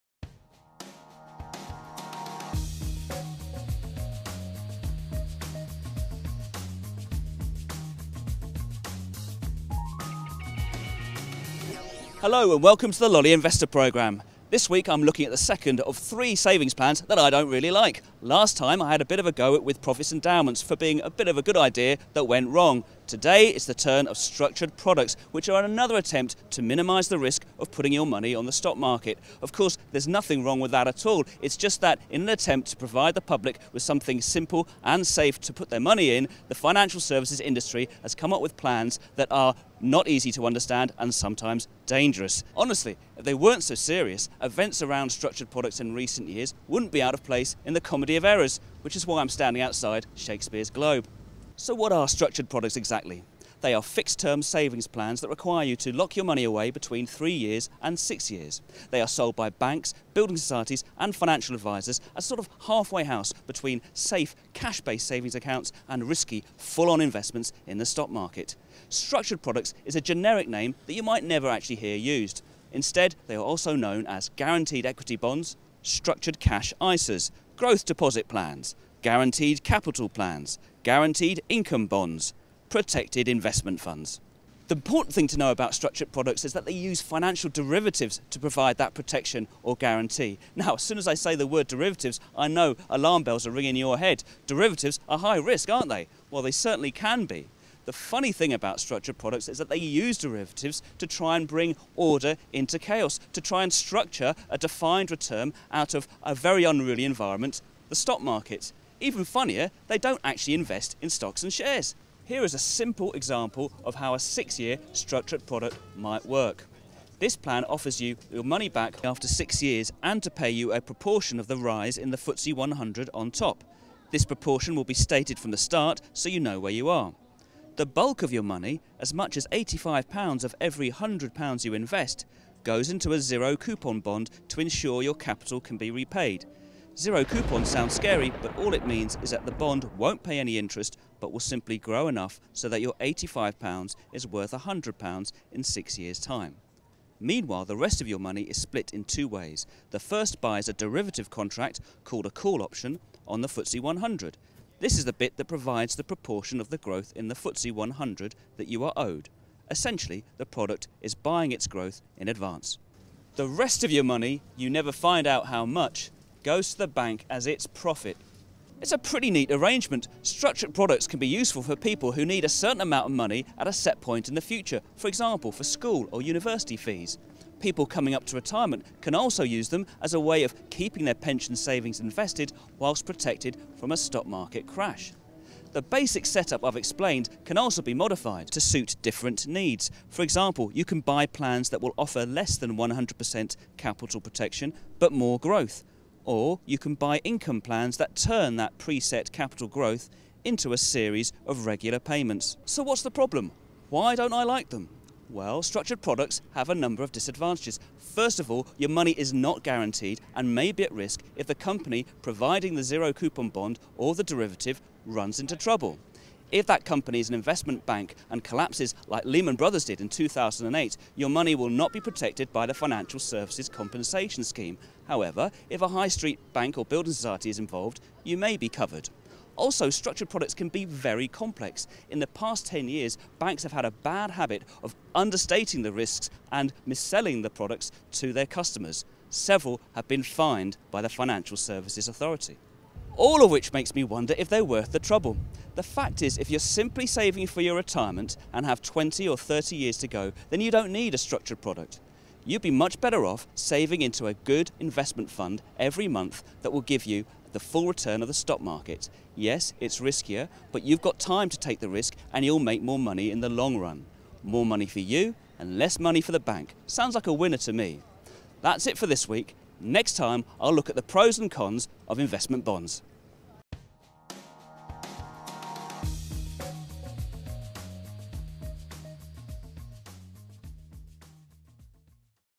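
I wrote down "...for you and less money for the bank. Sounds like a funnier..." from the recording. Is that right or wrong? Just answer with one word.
wrong.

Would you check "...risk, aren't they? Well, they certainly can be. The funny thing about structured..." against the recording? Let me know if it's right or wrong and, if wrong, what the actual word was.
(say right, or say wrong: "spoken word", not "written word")
right.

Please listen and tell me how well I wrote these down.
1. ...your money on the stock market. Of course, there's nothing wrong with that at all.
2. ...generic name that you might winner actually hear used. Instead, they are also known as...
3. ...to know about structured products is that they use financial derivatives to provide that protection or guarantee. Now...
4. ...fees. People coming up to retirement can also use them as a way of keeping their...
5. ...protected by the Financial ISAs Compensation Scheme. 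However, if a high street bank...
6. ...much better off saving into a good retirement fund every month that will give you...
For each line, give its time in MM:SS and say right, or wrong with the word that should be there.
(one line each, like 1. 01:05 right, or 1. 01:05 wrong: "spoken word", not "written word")
1. 00:27 right
2. 01:10 wrong: "never", not "winner"
3. 01:25 right
4. 02:56 right
5. 03:42 wrong: "Services", not "ISAs"
6. 04:12 wrong: "investment", not "retirement".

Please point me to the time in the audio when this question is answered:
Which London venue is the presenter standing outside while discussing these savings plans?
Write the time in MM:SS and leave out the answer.
00:50.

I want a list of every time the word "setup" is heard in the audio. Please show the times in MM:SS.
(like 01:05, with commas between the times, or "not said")
03:06.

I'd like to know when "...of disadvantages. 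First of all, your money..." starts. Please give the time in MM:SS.
03:27.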